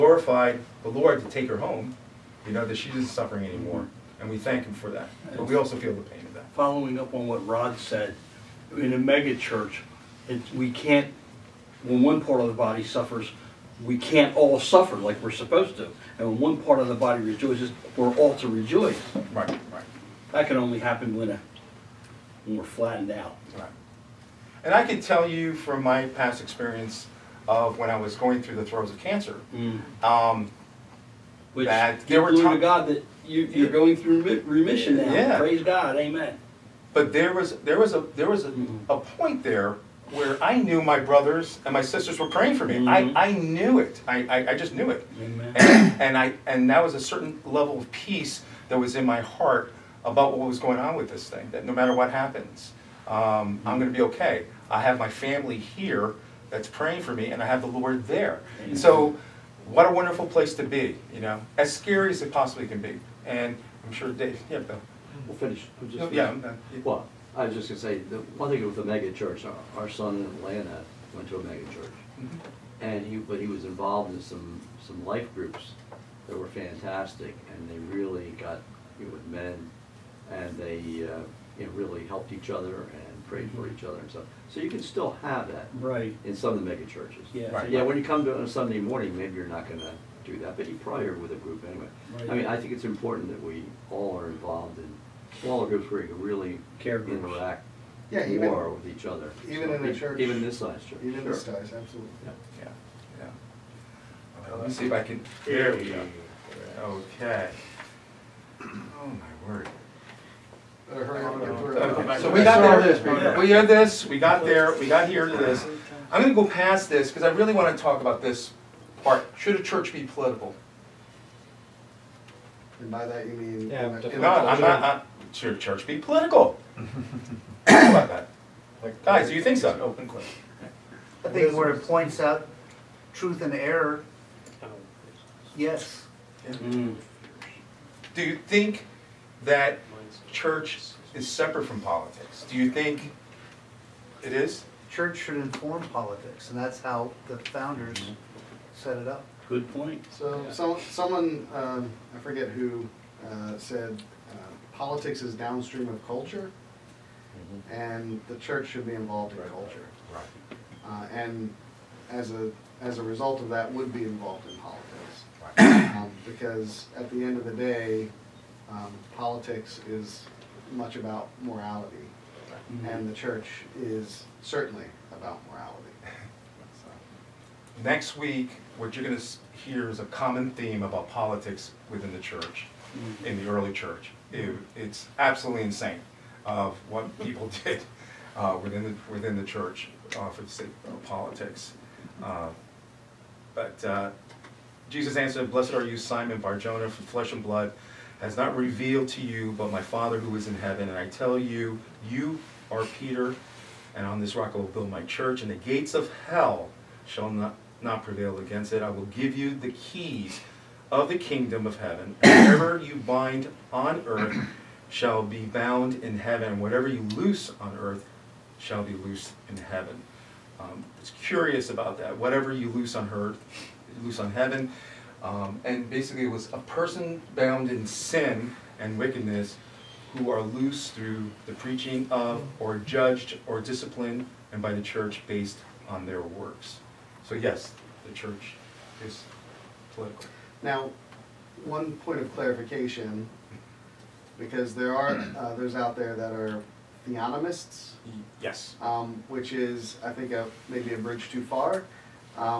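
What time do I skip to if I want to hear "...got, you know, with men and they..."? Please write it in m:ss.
1:18.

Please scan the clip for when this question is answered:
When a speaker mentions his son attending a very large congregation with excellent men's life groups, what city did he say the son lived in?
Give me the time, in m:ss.
1:10.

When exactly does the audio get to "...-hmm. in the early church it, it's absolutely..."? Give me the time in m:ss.
3:02.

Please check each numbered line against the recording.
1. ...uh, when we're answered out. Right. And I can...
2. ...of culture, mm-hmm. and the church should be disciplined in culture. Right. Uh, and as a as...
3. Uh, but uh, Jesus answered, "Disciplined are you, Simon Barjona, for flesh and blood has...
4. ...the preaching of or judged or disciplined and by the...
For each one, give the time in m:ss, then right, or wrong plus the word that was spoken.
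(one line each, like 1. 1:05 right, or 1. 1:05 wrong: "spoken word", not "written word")
1. 0:21 wrong: "flattened", not "answered"
2. 2:35 wrong: "involved", not "disciplined"
3. 3:12 wrong: "Blessed", not "Disciplined"
4. 3:51 right.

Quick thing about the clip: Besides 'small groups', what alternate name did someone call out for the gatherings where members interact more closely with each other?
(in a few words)
Care groups.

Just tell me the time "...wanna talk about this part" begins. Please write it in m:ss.
1:57.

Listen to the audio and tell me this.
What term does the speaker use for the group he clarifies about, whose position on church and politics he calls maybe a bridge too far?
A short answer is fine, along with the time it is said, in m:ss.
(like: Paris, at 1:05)
theonomists, at 4:07.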